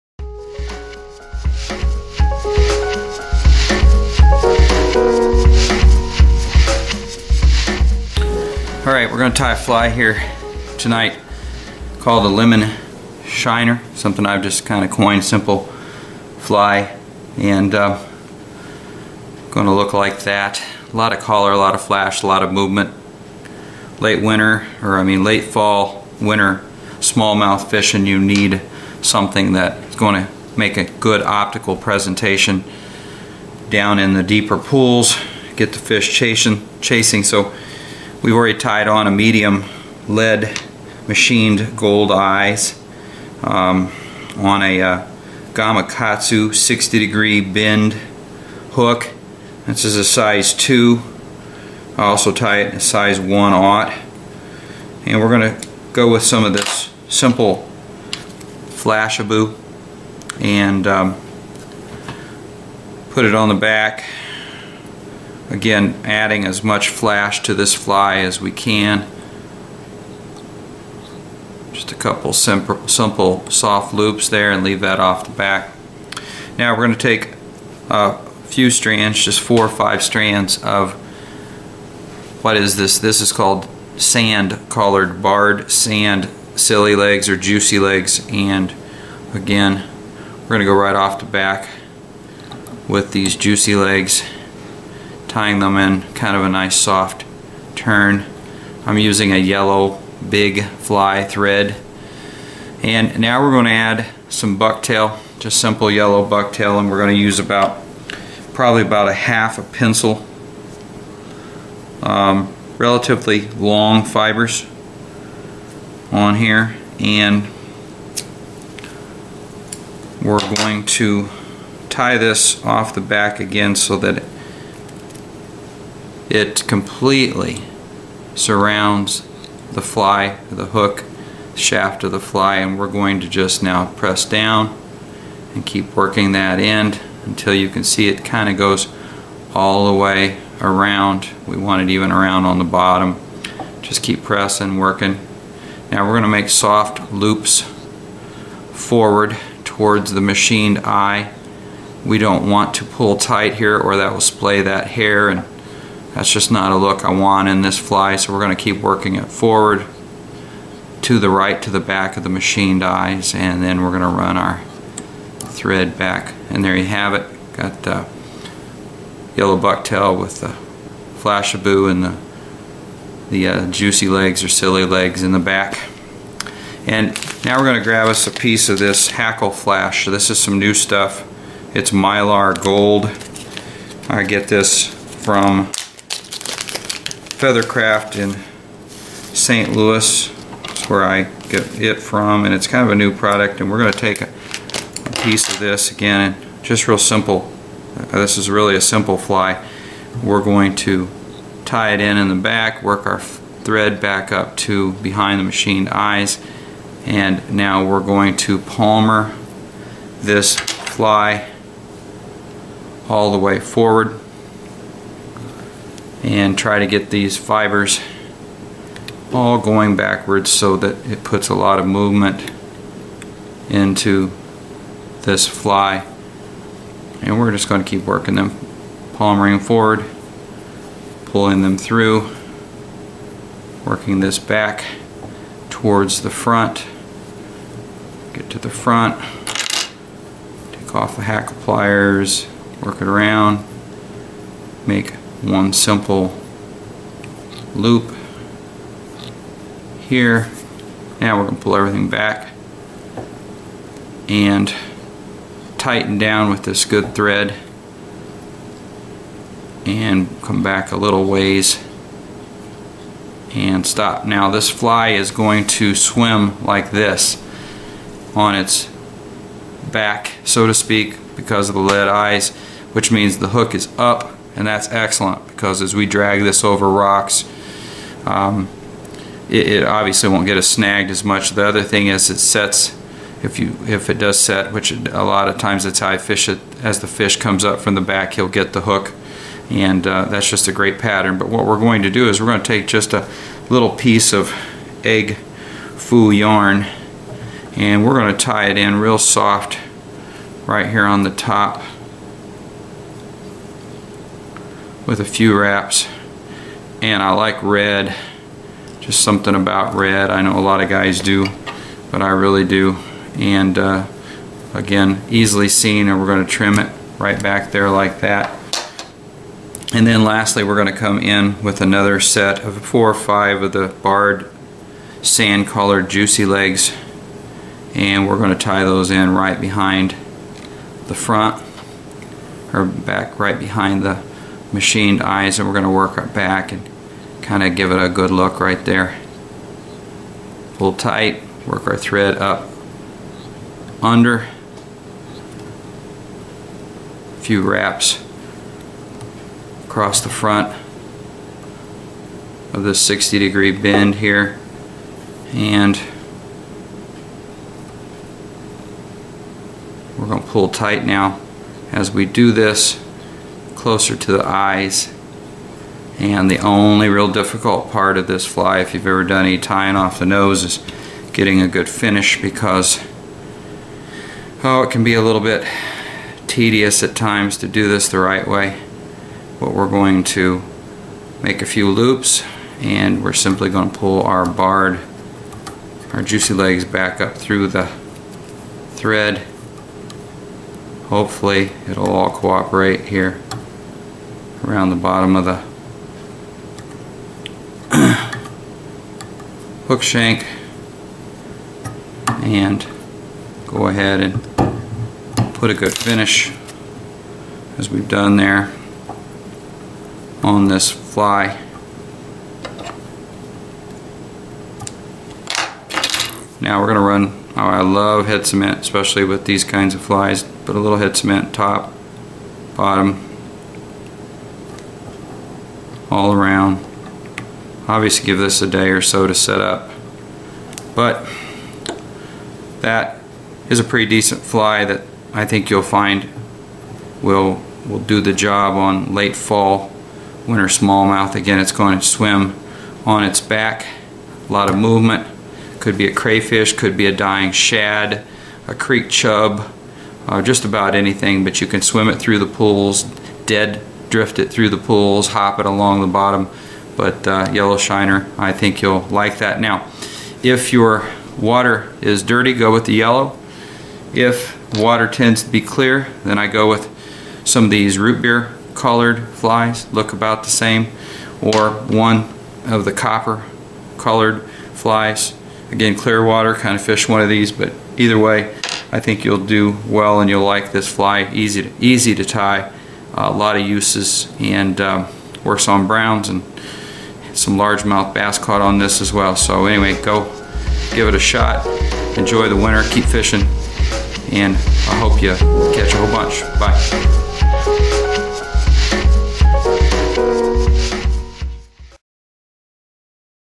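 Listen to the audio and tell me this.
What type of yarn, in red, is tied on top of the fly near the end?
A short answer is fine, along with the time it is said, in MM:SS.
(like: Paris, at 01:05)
Egg foo yarn, at 04:55.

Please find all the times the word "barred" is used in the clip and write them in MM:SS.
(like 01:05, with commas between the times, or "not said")
01:25, 05:24, 06:24.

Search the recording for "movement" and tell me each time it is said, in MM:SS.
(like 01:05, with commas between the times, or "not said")
00:22, 03:41, 07:24.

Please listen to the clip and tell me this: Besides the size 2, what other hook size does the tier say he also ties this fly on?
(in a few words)
1/0.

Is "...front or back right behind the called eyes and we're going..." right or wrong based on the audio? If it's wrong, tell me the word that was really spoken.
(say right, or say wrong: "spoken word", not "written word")
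wrong: "machined", not "called".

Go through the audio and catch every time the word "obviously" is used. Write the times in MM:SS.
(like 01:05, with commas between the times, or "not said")
04:39, 07:07.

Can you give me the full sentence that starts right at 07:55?
Again, clear water, kind of fish one of these, but either way, I think you'll do well and you'll like this fly.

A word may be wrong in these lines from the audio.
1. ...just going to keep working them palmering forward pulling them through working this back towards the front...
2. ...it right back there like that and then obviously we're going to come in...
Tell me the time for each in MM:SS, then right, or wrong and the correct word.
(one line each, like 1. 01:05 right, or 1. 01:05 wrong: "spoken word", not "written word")
1. 03:47 right
2. 05:16 wrong: "lastly", not "obviously".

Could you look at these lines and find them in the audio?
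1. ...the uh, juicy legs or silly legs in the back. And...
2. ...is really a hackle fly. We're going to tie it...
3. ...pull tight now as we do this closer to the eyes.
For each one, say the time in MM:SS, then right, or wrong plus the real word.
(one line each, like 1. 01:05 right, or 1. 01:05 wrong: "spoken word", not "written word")
1. 02:53 right
2. 03:18 wrong: "simple", not "hackle"
3. 06:00 right.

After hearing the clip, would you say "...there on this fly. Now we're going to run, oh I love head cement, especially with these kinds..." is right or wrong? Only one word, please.
right.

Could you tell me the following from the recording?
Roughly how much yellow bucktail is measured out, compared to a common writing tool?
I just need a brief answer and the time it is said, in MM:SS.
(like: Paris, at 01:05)
Half a pencil, at 01:49.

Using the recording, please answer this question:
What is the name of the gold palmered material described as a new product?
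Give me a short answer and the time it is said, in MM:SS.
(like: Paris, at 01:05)
Mylar Gold, at 03:01.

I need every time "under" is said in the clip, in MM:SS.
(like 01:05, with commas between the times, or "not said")
05:44.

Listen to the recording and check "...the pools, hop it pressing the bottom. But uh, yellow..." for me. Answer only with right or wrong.
wrong.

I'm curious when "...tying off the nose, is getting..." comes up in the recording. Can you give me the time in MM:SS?
06:09.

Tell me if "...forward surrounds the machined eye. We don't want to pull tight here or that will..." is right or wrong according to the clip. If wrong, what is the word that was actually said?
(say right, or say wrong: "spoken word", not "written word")
wrong: "towards", not "surrounds".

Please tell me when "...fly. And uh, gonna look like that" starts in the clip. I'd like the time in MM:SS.
00:16.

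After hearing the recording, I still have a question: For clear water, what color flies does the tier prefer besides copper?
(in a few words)
Root beer.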